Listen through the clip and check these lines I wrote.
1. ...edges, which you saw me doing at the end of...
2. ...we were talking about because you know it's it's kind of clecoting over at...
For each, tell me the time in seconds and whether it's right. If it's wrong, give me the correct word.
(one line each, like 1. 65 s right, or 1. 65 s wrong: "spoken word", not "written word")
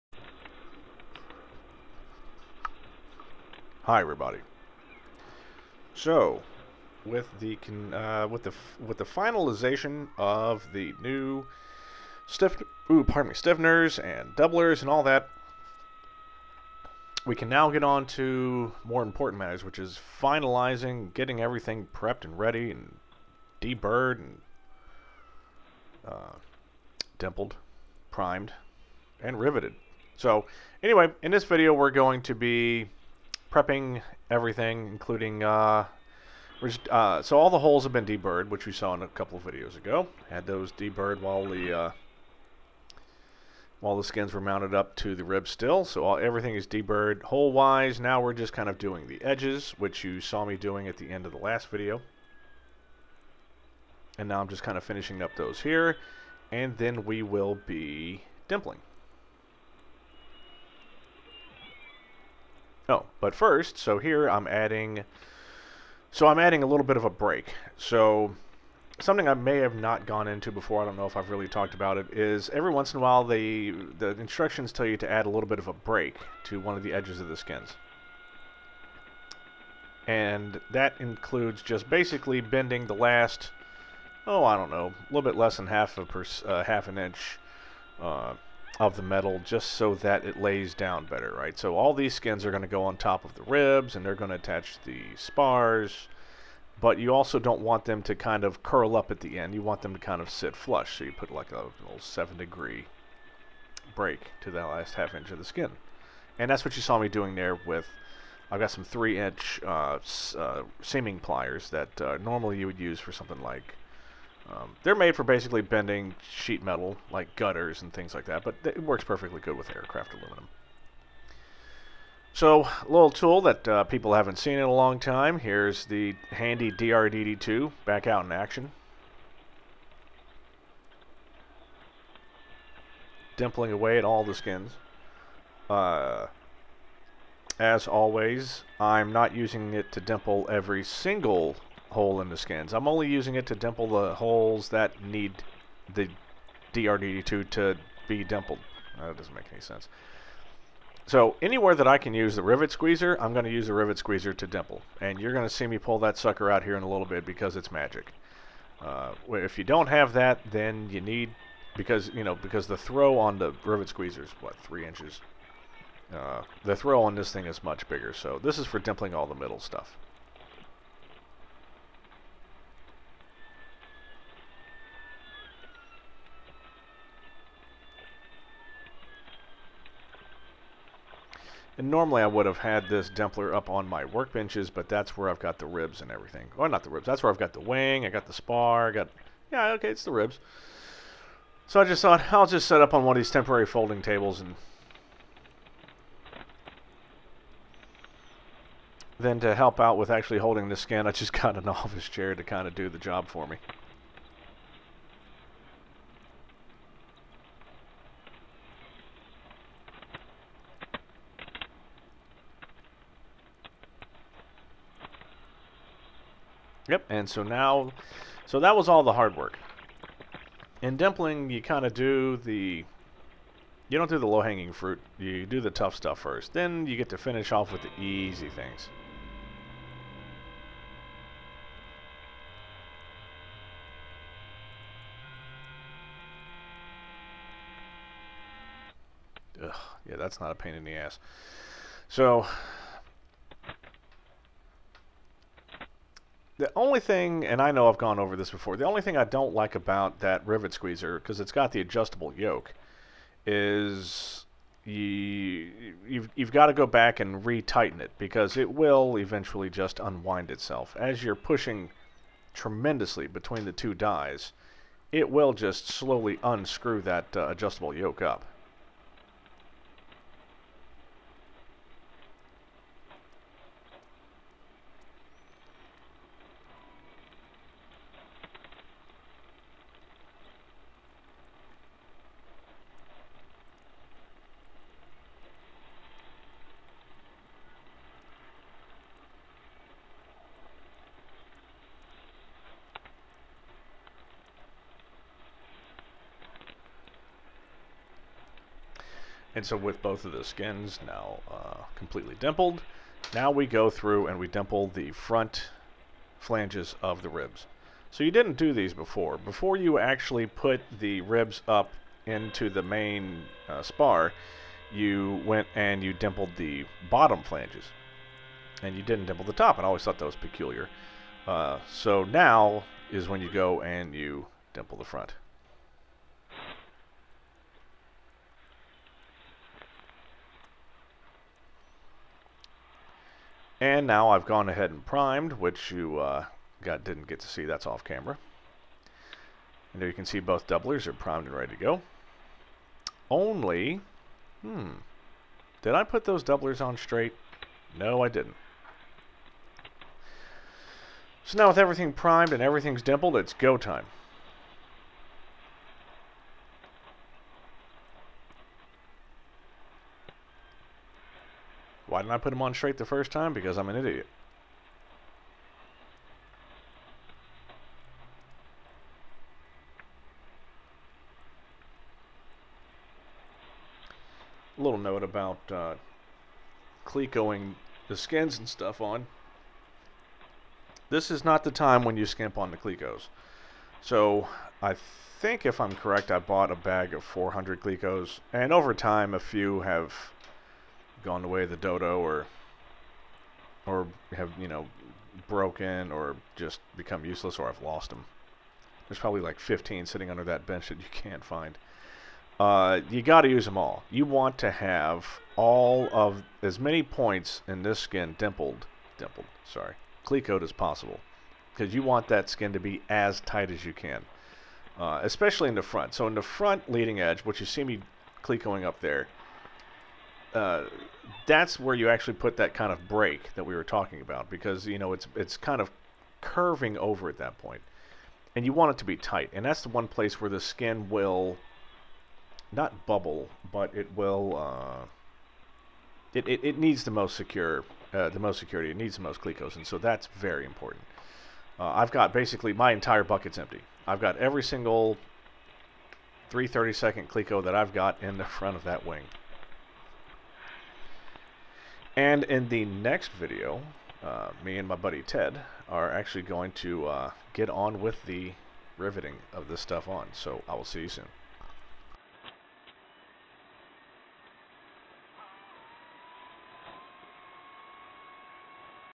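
1. 49 s right
2. 423 s wrong: "curving", not "clecoting".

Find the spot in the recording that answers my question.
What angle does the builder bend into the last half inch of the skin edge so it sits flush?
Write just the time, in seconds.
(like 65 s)
101 s.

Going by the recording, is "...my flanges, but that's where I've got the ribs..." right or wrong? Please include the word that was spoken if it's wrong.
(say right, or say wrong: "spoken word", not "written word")
wrong: "workbenches", not "flanges".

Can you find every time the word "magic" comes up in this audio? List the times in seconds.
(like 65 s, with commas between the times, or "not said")
157 s.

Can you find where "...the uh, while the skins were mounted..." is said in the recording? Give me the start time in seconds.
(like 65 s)
41 s.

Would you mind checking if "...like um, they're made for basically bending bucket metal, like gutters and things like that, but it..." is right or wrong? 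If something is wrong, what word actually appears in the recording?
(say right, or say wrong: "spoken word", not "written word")
wrong: "sheet", not "bucket".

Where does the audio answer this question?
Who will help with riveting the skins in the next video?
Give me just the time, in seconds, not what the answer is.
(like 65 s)
455 s.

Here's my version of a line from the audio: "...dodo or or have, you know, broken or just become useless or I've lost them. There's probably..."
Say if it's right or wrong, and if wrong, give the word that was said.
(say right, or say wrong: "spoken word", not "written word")
right.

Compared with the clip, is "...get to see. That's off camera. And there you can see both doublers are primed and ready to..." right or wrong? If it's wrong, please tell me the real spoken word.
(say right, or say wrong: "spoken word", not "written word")
right.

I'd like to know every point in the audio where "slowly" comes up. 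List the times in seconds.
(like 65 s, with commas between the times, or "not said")
265 s.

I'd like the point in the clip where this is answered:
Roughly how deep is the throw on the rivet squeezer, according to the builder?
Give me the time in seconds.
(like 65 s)
164 s.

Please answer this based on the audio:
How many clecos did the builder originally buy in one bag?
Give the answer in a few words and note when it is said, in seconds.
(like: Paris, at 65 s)
400, at 387 s.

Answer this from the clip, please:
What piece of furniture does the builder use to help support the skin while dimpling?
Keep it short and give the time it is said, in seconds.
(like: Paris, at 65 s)
office chair, at 201 s.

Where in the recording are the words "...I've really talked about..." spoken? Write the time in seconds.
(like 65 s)
71 s.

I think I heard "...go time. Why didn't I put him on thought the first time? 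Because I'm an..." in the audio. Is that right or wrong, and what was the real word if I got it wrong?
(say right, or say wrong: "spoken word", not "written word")
wrong: "straight", not "thought".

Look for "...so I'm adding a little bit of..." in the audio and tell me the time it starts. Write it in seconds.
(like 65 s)
66 s.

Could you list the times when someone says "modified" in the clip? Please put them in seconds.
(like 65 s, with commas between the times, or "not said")
not said.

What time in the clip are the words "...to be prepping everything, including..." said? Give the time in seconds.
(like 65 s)
32 s.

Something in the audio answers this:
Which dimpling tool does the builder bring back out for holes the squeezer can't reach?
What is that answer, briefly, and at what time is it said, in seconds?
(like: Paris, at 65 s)
DRDT2, at 126 s.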